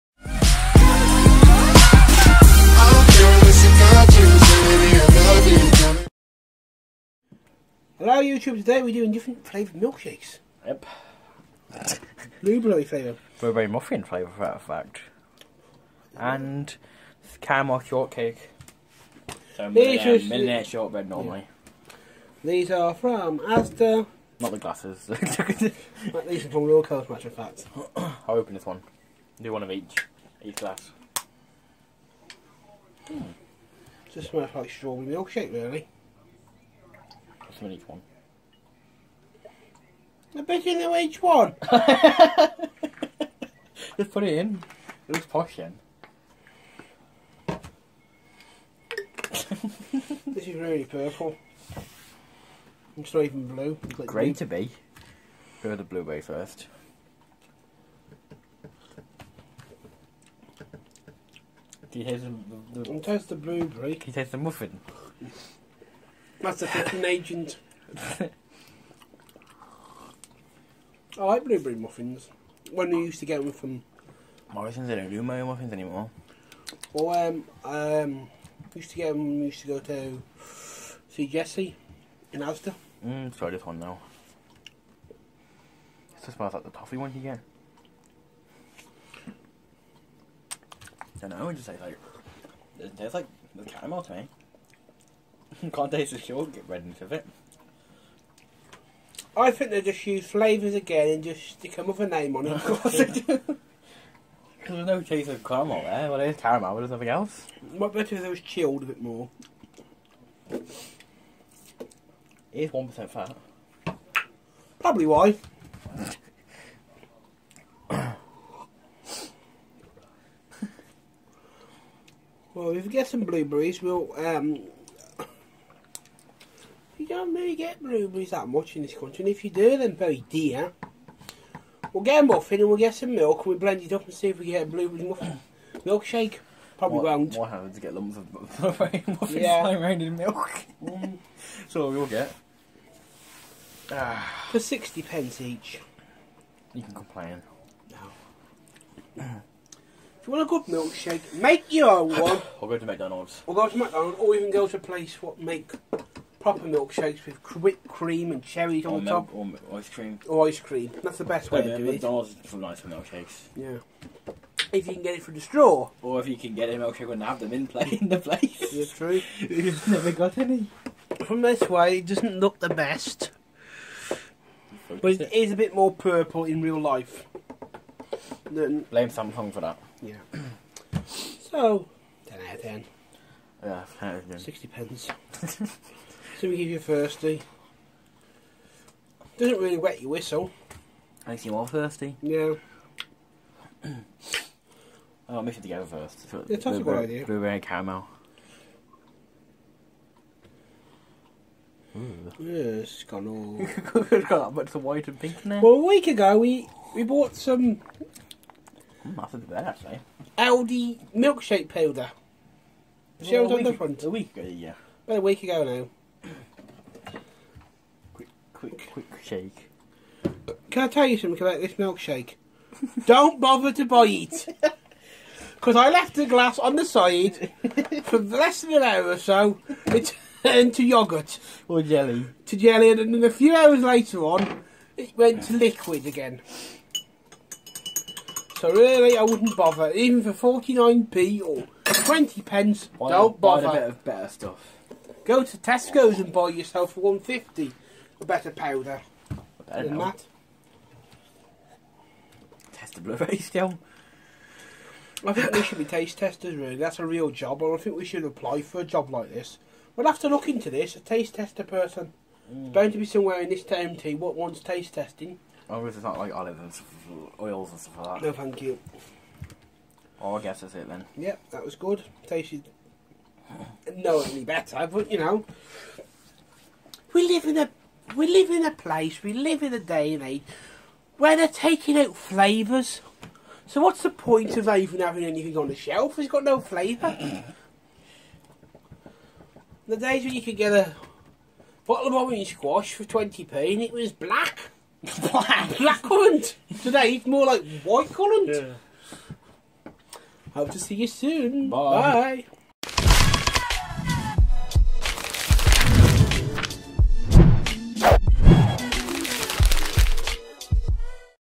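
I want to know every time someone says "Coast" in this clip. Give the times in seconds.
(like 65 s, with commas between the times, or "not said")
26 s.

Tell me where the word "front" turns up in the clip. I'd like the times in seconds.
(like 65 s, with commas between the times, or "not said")
213 s.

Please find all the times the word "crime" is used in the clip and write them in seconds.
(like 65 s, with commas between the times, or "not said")
not said.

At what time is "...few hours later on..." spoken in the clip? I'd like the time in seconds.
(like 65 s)
233 s.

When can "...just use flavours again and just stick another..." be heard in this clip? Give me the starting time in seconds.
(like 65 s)
99 s.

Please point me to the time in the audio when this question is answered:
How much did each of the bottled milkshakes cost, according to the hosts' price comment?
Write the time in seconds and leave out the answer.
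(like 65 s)
144 s.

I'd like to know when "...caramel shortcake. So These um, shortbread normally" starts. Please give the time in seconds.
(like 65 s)
17 s.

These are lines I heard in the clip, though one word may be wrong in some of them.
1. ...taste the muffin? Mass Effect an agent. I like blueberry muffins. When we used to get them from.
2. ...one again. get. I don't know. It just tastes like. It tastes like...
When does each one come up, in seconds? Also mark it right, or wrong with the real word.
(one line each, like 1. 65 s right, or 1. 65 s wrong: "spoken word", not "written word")
1. 64 s right
2. 86 s right.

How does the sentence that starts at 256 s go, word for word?
That's a real job, or I think we should apply for a job like this.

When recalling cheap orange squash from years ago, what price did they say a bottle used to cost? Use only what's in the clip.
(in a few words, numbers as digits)
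20p.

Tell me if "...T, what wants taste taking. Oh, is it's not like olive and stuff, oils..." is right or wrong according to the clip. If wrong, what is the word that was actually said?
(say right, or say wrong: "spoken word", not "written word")
wrong: "testing", not "taking".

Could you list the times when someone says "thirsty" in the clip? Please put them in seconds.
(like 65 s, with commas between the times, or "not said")
186 s, 191 s.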